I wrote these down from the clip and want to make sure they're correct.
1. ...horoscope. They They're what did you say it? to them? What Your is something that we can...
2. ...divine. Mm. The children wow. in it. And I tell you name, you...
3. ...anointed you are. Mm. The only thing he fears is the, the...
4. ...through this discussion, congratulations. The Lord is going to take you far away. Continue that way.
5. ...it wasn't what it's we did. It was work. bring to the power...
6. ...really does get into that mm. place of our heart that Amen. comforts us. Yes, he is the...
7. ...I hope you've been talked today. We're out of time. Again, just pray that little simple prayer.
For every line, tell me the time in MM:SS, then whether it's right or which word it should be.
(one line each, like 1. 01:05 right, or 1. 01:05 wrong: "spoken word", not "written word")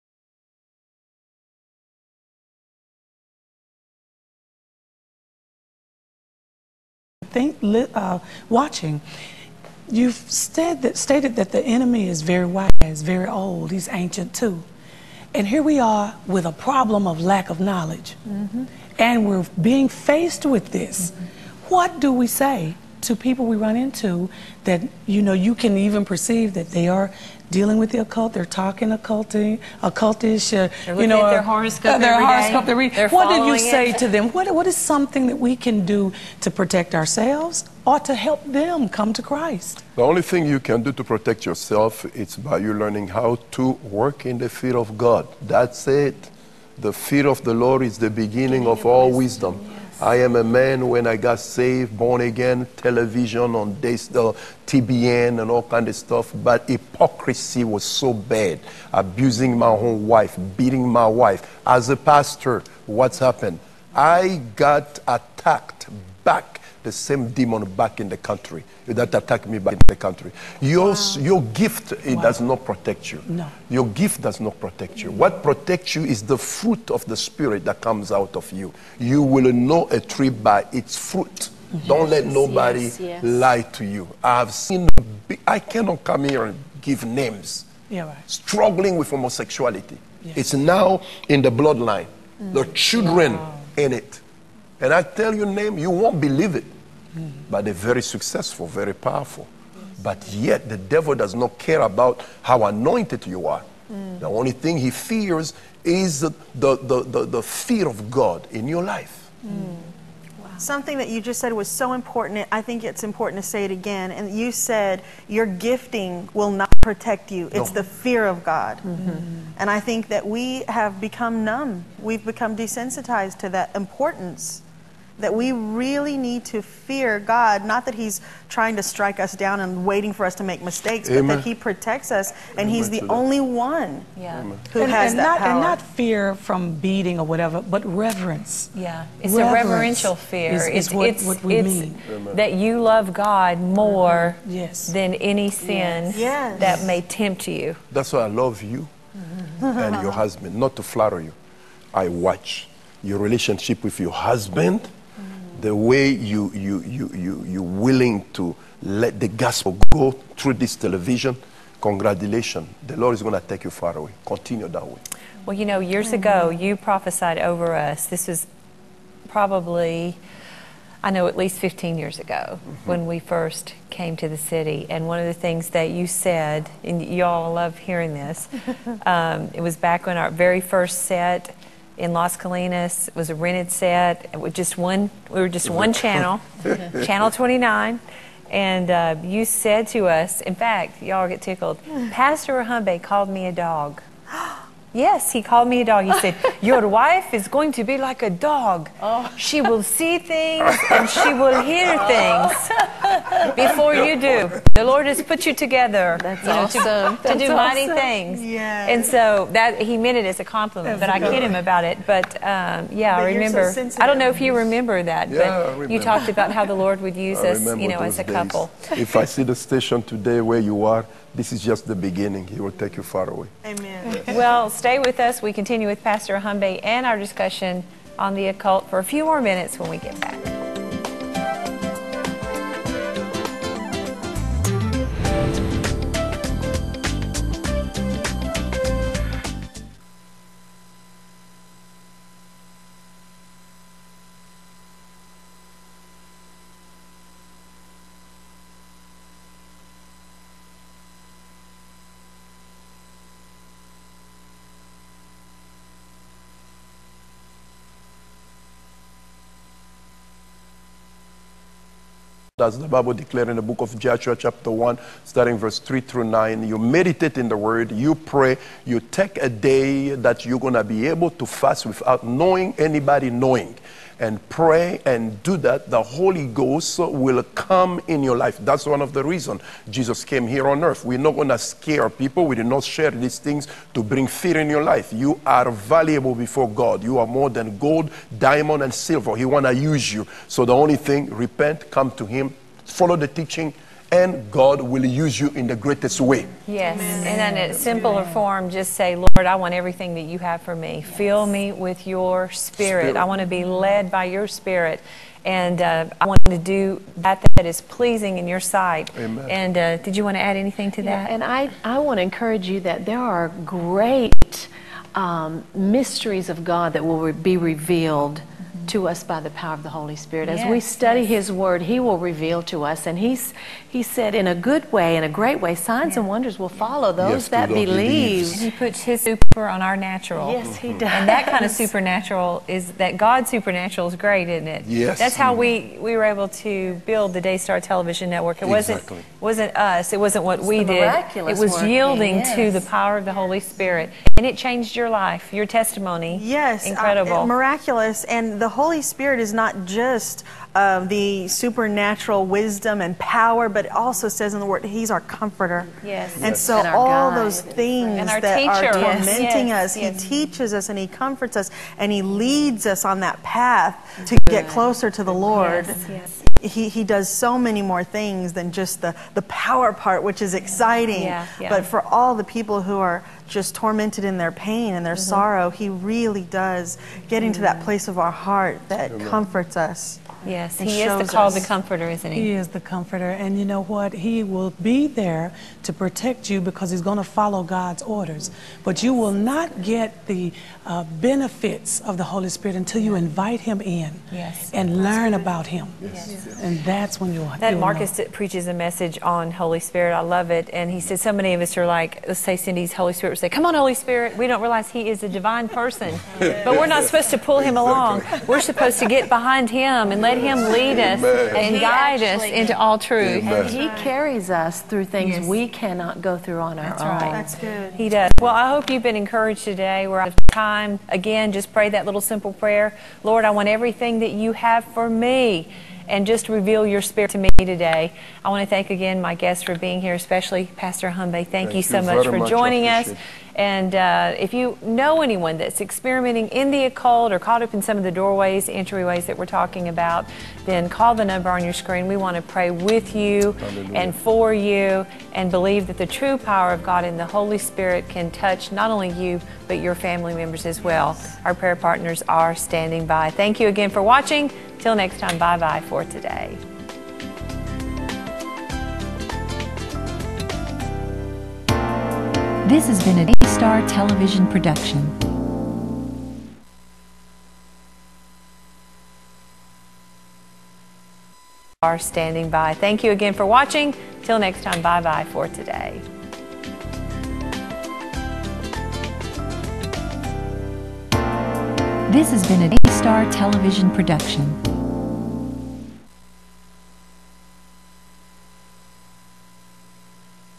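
1. 00:32 wrong: "What", not "Your"
2. 01:31 wrong: "bloodline", not "divine"
3. 01:42 right
4. 02:40 wrong: "television", not "discussion"
5. 05:40 wrong: "yielding", not "bring"
6. 06:15 right
7. 06:58 wrong: "encouraged", not "talked".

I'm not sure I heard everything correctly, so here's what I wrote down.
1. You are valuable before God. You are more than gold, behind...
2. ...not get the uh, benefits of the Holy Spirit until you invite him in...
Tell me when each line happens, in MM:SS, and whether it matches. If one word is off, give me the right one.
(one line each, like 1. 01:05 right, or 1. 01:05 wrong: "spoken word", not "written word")
1. 04:45 wrong: "diamond", not "behind"
2. 06:29 right.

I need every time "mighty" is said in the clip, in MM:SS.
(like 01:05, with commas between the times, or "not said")
03:27.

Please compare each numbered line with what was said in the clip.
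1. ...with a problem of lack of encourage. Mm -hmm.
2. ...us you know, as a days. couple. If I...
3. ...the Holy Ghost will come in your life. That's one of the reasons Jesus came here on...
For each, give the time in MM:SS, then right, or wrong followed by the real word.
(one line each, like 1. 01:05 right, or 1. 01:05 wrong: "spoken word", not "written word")
1. 00:16 wrong: "knowledge", not "encourage"
2. 03:37 right
3. 04:35 right.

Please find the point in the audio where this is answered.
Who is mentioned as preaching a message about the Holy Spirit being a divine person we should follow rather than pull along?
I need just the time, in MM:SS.
06:37.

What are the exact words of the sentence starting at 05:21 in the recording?
His Word, He will reveal to us.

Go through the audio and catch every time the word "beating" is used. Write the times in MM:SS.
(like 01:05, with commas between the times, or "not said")
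01:00, 02:16.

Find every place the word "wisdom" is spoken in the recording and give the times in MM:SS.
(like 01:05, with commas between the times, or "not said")
00:49, 05:52.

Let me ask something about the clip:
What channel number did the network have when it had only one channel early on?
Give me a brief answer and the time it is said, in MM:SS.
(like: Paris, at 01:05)
29, at 03:07.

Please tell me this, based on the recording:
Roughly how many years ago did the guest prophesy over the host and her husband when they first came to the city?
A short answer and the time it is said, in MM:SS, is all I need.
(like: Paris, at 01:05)
15, at 02:51.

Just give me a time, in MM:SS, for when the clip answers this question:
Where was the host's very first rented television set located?
03:02.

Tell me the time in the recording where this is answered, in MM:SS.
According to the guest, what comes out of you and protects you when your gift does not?
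01:16.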